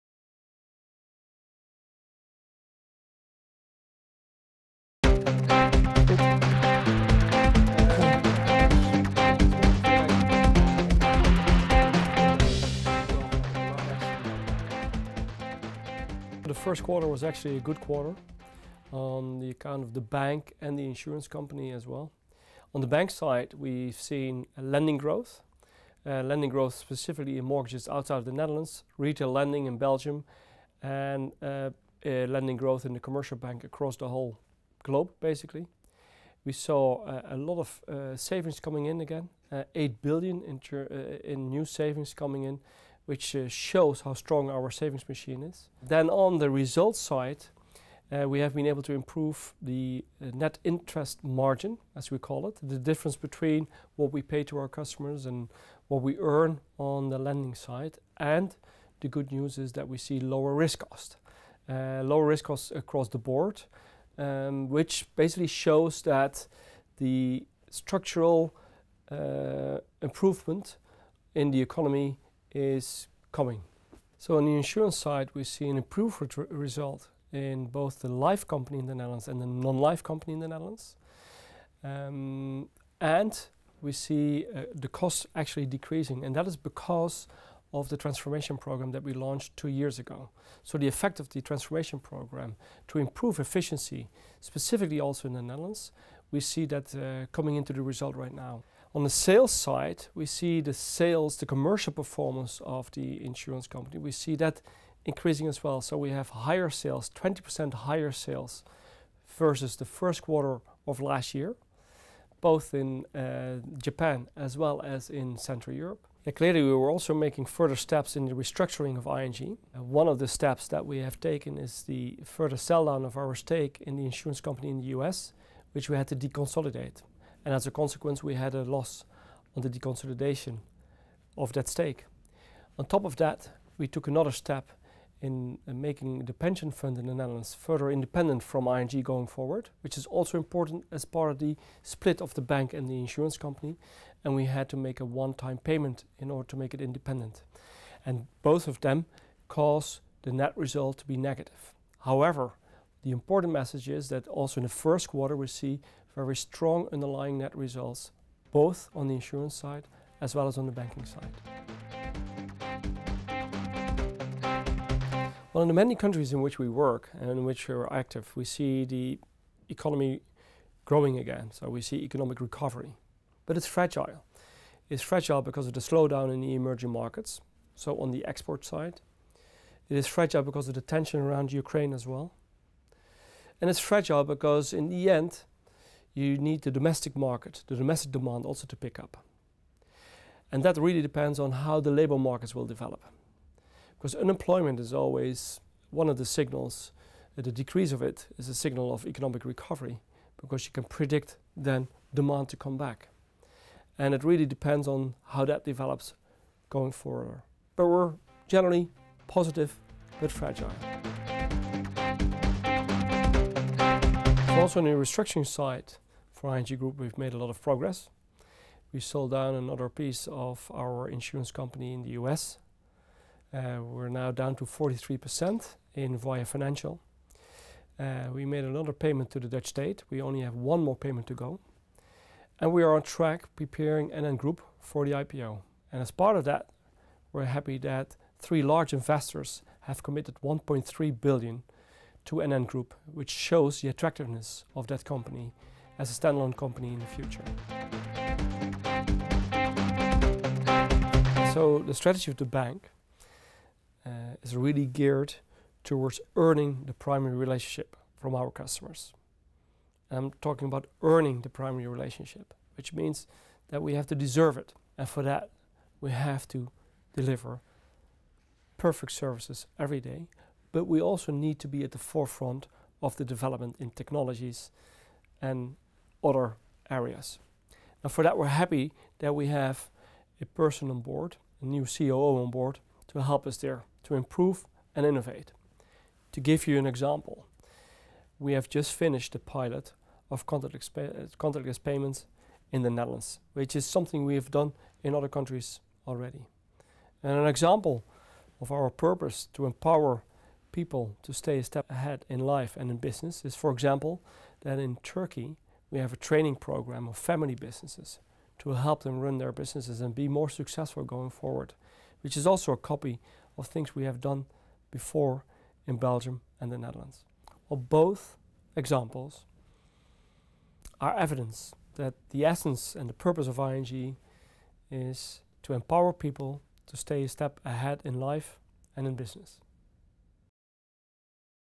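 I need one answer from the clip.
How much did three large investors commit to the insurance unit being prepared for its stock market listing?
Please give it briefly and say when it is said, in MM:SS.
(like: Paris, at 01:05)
1.3 billion, at 04:00.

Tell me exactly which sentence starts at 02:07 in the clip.
And as a consequence, we had a loss on the deconsolidation of that stake.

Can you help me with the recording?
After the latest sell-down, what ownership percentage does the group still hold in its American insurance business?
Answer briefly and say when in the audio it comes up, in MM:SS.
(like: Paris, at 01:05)
43%, at 03:44.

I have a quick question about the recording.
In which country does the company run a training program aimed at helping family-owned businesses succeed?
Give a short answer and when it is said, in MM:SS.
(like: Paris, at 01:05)
Turkey, at 05:05.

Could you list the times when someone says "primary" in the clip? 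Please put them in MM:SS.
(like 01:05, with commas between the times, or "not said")
04:16, 04:21.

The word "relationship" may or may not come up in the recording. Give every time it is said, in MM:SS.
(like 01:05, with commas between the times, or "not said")
04:17, 04:21.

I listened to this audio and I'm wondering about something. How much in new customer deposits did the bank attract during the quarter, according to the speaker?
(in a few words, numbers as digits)
8 billion.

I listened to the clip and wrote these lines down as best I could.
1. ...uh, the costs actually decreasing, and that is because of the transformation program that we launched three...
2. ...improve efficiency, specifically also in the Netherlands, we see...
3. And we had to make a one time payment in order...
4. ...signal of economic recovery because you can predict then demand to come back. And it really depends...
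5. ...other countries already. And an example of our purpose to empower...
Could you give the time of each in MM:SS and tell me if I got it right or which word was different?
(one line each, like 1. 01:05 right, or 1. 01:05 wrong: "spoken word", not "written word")
1. 01:24 wrong: "two", not "three"
2. 01:32 right
3. 02:24 right
4. 03:18 right
5. 04:55 right.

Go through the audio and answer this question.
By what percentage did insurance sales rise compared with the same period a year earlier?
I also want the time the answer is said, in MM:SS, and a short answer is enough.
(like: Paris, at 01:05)
20%, at 01:47.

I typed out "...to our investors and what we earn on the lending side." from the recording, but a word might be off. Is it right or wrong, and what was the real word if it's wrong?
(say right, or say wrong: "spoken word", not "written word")
wrong: "customers", not "investors".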